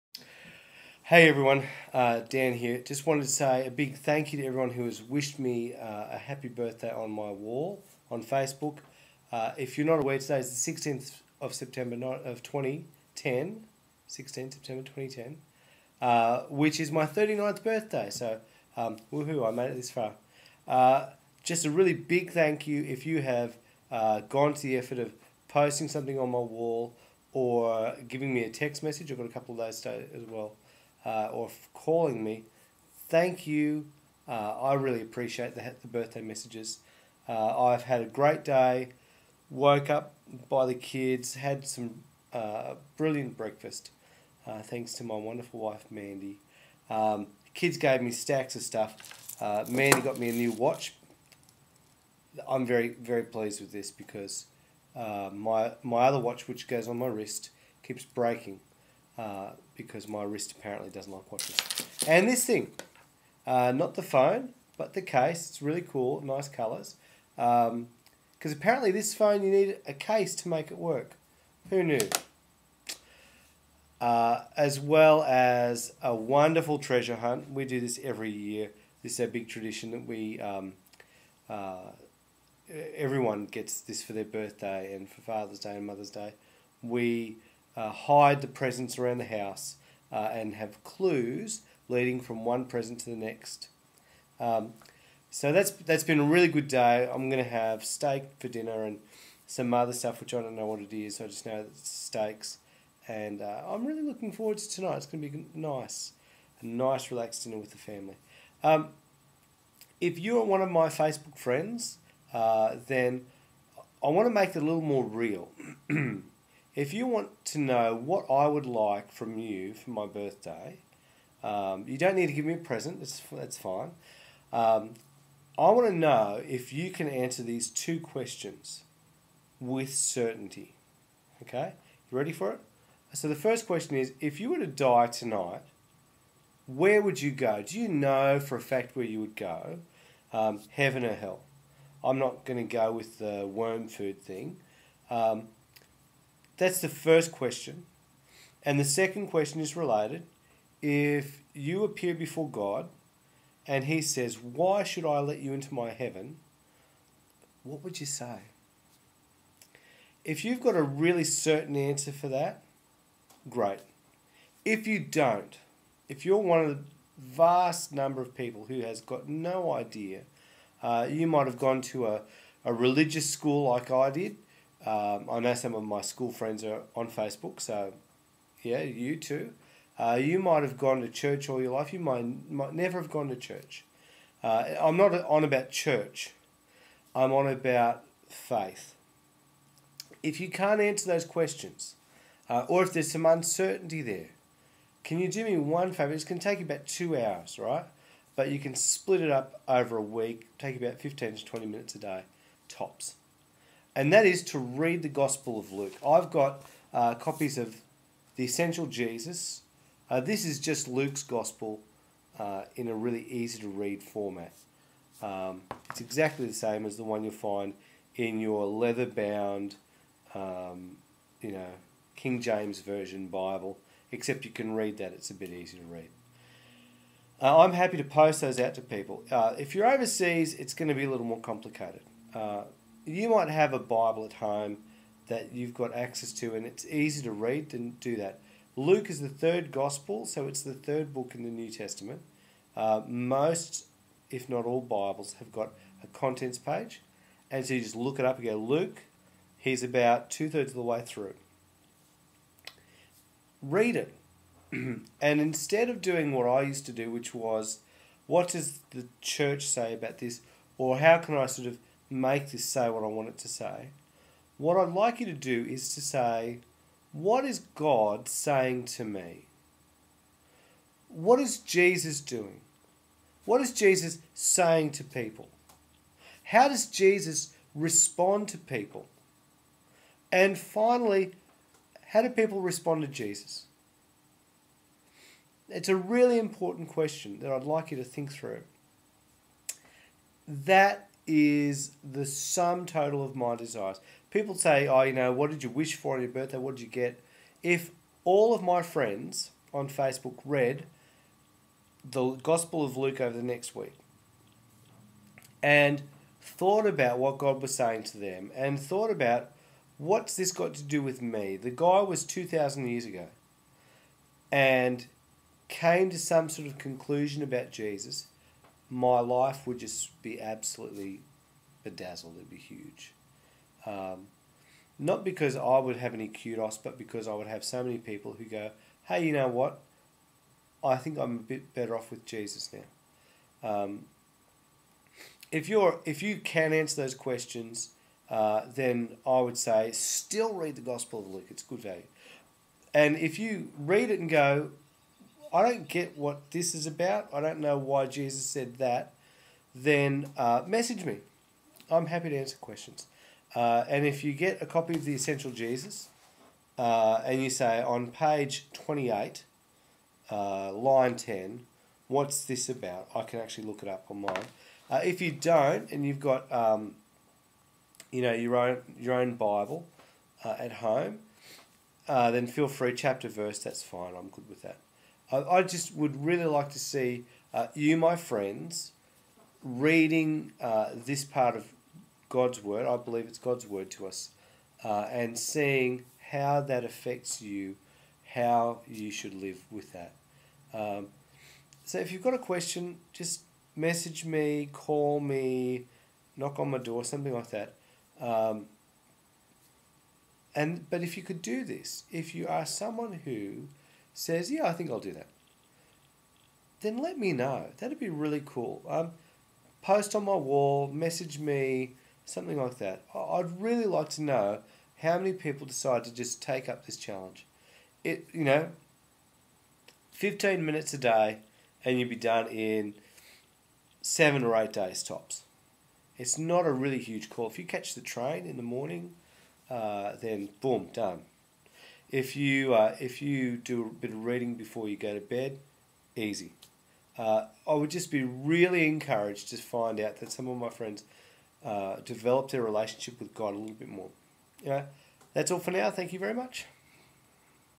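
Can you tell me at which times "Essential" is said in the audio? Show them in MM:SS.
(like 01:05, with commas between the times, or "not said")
03:28, 05:55.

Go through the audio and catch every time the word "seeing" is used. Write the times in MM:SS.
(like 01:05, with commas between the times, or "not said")
06:25.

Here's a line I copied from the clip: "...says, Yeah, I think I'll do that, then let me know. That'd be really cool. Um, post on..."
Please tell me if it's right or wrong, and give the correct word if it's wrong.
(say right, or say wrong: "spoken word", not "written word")
right.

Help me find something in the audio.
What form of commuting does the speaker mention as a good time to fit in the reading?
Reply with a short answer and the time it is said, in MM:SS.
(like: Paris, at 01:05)
The train, at 07:07.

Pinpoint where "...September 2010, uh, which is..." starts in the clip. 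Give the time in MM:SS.
00:14.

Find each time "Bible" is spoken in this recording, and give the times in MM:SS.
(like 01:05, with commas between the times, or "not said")
03:43, 03:53, 04:04, 06:09.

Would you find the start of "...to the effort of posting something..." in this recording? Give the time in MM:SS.
00:24.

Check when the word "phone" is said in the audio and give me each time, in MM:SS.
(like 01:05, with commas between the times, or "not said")
01:04, 01:09.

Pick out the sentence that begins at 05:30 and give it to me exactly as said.
I think I'm a bit better off with Jesus now.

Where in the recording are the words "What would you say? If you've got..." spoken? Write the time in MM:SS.
02:37.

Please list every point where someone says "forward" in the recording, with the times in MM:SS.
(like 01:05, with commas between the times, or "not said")
01:44.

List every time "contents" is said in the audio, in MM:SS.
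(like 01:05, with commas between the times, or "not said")
04:06.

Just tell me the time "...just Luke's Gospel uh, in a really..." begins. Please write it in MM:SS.
03:30.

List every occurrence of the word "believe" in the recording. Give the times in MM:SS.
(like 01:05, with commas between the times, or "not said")
06:22.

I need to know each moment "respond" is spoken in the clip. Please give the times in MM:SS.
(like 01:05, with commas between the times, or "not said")
04:37, 04:42.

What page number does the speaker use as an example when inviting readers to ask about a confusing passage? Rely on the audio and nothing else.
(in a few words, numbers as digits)
28.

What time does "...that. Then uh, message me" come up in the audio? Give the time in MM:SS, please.
05:48.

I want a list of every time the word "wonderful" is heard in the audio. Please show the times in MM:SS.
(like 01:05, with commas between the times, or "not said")
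00:45, 01:16.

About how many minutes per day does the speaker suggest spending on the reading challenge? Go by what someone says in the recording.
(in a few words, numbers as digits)
15 to 20 minutes.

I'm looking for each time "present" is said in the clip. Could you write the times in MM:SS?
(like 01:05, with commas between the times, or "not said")
01:28, 01:32, 02:02.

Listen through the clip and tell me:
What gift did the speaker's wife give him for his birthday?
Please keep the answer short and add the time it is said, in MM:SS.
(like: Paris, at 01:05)
A new watch, at 00:50.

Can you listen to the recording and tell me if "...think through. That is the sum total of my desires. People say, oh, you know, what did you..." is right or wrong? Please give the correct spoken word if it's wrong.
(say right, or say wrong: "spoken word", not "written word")
right.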